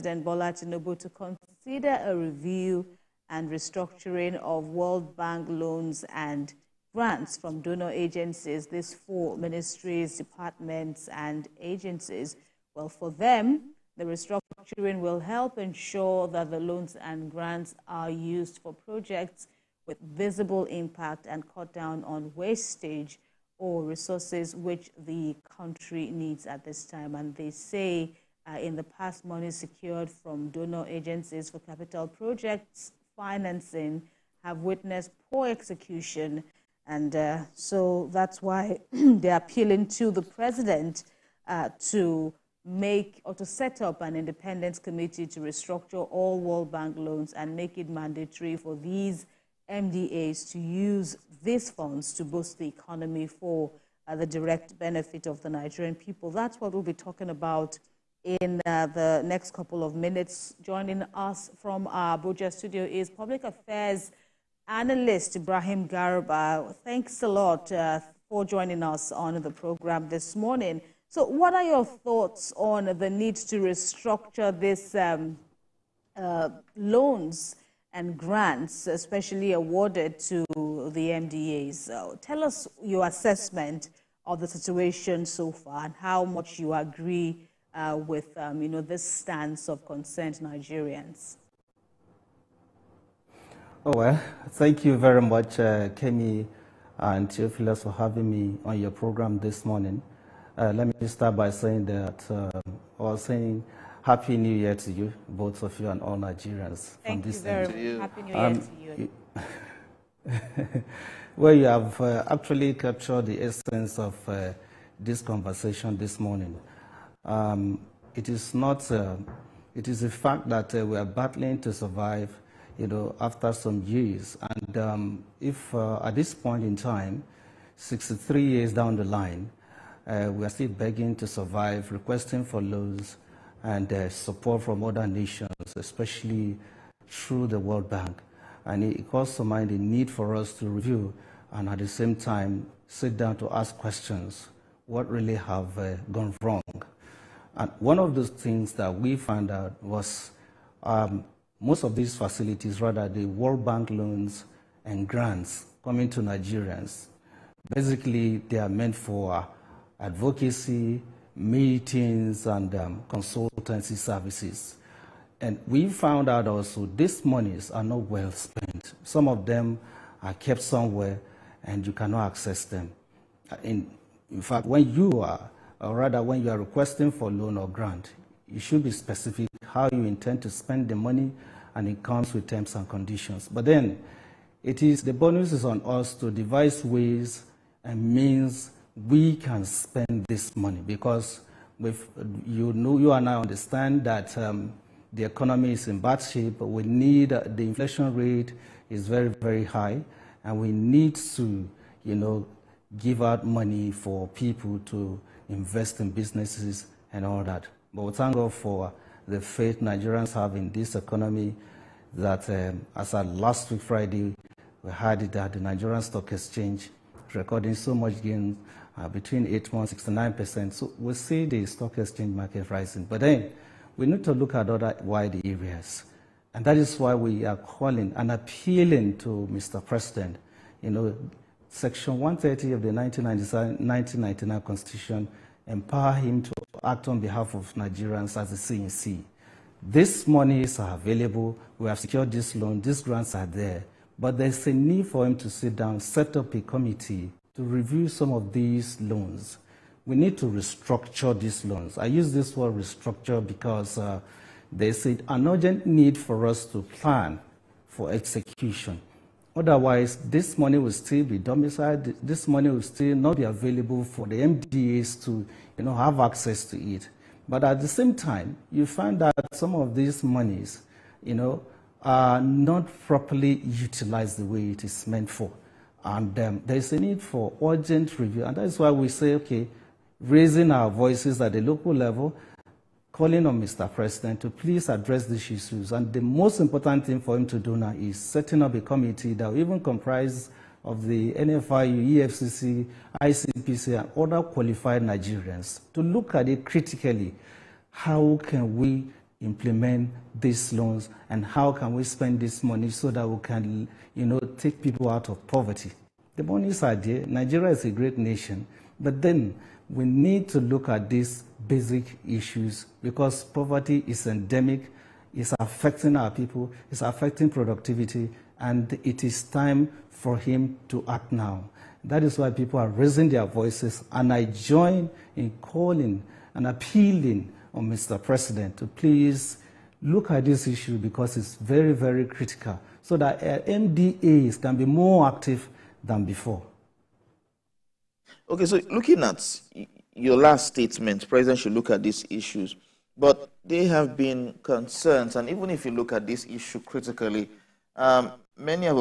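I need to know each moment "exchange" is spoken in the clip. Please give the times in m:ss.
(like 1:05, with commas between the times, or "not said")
3:36, 3:41.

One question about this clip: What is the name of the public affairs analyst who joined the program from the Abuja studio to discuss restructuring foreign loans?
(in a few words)
Ibrahim Garba.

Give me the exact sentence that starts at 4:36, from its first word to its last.
And um, there is a need for urgent review.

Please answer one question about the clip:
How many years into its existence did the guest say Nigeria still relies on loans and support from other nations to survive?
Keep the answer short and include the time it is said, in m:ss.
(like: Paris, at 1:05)
63 years, at 2:07.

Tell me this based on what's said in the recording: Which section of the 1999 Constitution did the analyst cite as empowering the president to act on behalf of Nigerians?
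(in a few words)
Section 130.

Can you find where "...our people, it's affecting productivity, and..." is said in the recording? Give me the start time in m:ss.
5:16.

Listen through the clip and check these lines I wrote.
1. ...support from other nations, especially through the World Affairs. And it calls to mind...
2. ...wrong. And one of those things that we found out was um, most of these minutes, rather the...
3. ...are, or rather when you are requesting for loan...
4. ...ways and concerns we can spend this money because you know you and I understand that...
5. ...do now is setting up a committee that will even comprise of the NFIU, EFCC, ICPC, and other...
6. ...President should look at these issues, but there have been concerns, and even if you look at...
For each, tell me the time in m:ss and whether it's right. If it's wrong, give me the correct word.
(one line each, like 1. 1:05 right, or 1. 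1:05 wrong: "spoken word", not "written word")
1. 2:14 wrong: "Bank", not "Affairs"
2. 2:26 wrong: "facilities", not "minutes"
3. 2:55 right
4. 3:06 wrong: "means", not "concerns"
5. 4:47 right
6. 5:41 right.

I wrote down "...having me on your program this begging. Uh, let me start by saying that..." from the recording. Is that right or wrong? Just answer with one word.
wrong.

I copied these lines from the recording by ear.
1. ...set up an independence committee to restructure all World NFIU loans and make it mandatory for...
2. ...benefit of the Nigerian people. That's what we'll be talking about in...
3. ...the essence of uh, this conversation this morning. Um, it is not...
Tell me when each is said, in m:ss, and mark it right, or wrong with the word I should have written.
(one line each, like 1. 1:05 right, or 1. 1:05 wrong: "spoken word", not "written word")
1. 0:43 wrong: "Bank", not "NFIU"
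2. 0:54 right
3. 1:53 right.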